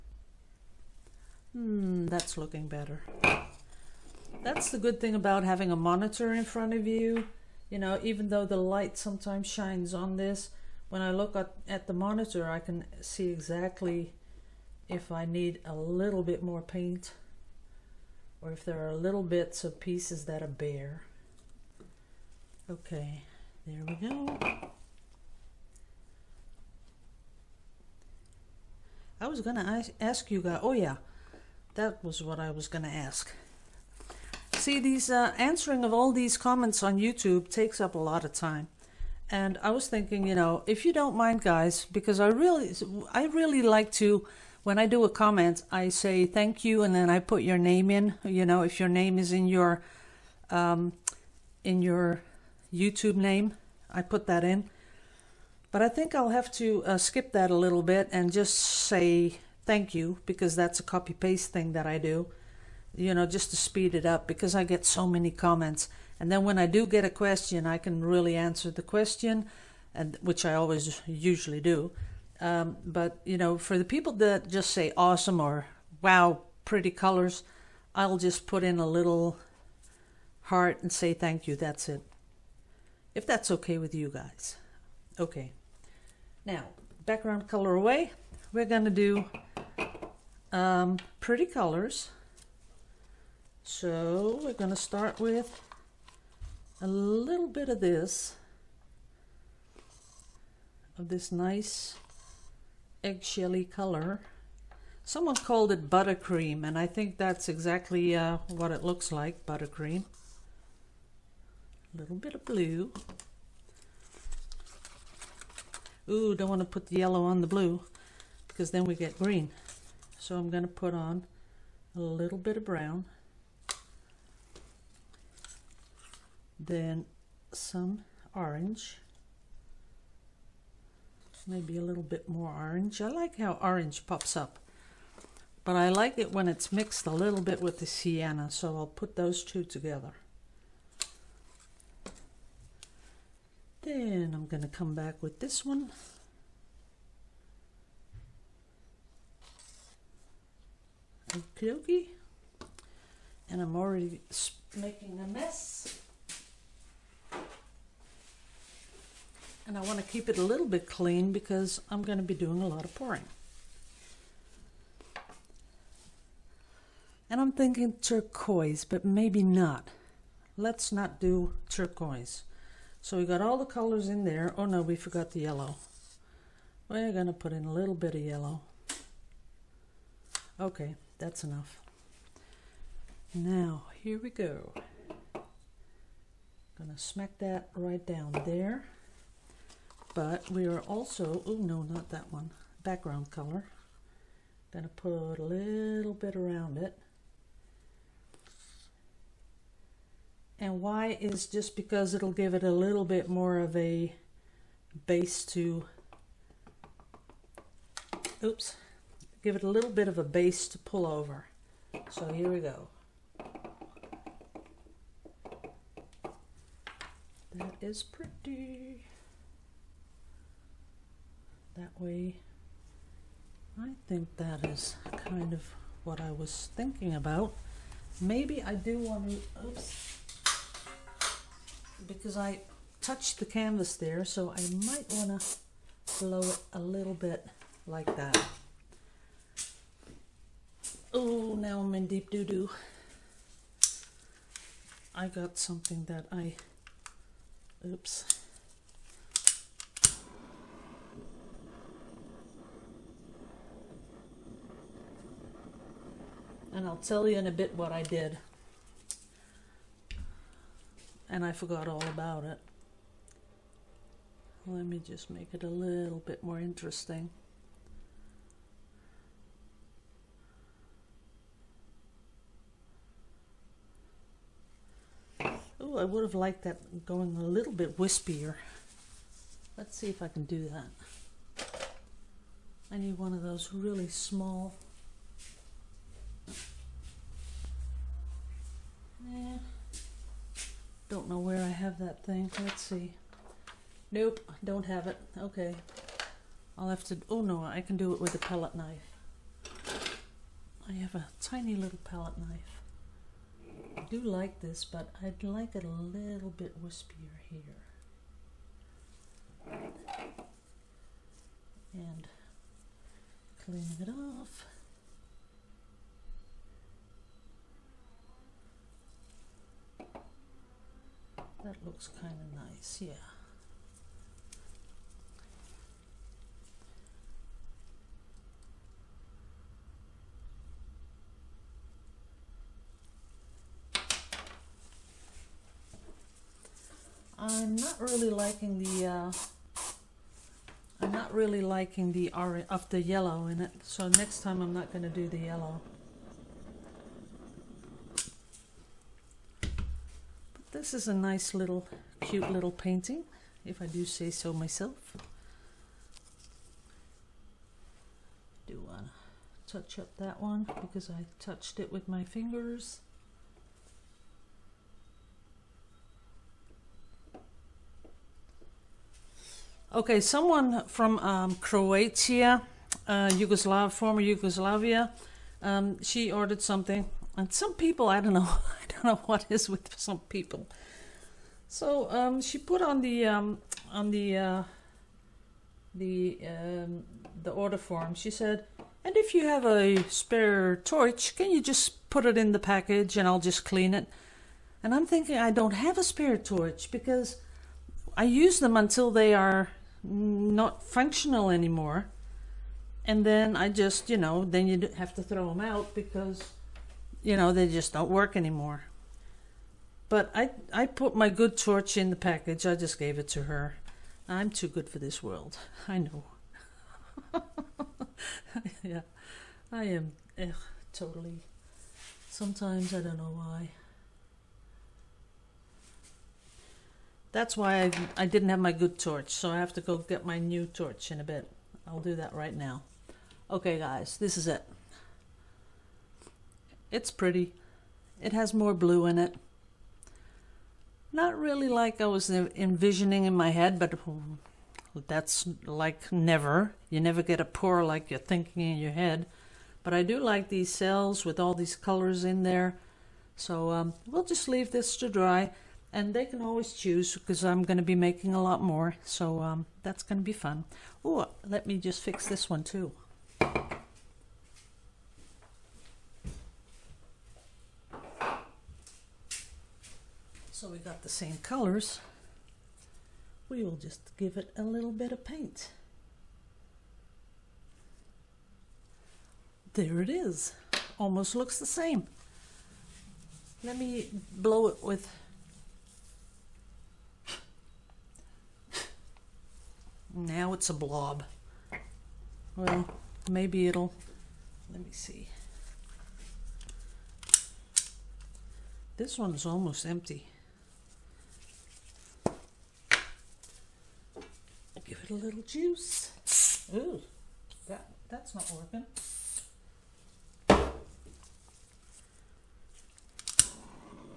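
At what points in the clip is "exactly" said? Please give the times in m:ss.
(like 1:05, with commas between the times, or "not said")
0:13, 1:47.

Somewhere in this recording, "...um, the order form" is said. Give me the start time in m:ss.
6:26.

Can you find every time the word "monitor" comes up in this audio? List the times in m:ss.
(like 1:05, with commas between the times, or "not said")
0:05, 0:11.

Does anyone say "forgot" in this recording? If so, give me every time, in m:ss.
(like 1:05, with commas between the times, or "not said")
2:54, 4:21.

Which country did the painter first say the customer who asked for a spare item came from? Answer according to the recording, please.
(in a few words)
Croatia.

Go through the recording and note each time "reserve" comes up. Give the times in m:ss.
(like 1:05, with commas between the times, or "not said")
not said.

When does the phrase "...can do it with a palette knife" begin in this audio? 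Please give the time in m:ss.
4:57.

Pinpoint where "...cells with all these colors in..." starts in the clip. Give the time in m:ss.
7:30.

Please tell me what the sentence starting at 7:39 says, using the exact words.
So um, that's going to be fun.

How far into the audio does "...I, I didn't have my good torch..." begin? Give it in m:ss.
7:07.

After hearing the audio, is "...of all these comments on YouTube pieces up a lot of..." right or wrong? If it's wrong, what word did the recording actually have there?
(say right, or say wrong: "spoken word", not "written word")
wrong: "takes", not "pieces".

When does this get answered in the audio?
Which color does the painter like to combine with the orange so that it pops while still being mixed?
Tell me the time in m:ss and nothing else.
2:17.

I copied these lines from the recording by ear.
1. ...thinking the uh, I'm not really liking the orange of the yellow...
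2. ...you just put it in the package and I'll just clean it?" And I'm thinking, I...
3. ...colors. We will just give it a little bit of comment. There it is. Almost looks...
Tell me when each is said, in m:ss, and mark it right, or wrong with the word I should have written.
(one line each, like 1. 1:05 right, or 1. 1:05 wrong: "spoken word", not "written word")
1. 5:38 wrong: "liking", not "thinking"
2. 6:31 right
3. 7:51 wrong: "paint", not "comment".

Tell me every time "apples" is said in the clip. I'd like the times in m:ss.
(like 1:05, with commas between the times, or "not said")
not said.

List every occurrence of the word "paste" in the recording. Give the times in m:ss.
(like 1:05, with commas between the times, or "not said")
1:01.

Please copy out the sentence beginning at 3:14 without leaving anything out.
Gonna put a little bit around it.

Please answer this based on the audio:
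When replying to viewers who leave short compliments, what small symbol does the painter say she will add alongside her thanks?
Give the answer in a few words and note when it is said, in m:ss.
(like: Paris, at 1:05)
a little heart, at 1:18.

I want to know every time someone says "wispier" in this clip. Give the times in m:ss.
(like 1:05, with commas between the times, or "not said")
4:37, 5:06.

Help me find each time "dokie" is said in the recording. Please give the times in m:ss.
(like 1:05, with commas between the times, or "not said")
2:31.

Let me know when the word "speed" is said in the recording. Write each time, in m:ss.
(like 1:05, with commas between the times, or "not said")
1:03.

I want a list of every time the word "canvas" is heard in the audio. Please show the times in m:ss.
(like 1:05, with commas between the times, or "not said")
3:53.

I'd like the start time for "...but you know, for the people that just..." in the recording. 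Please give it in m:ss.
1:12.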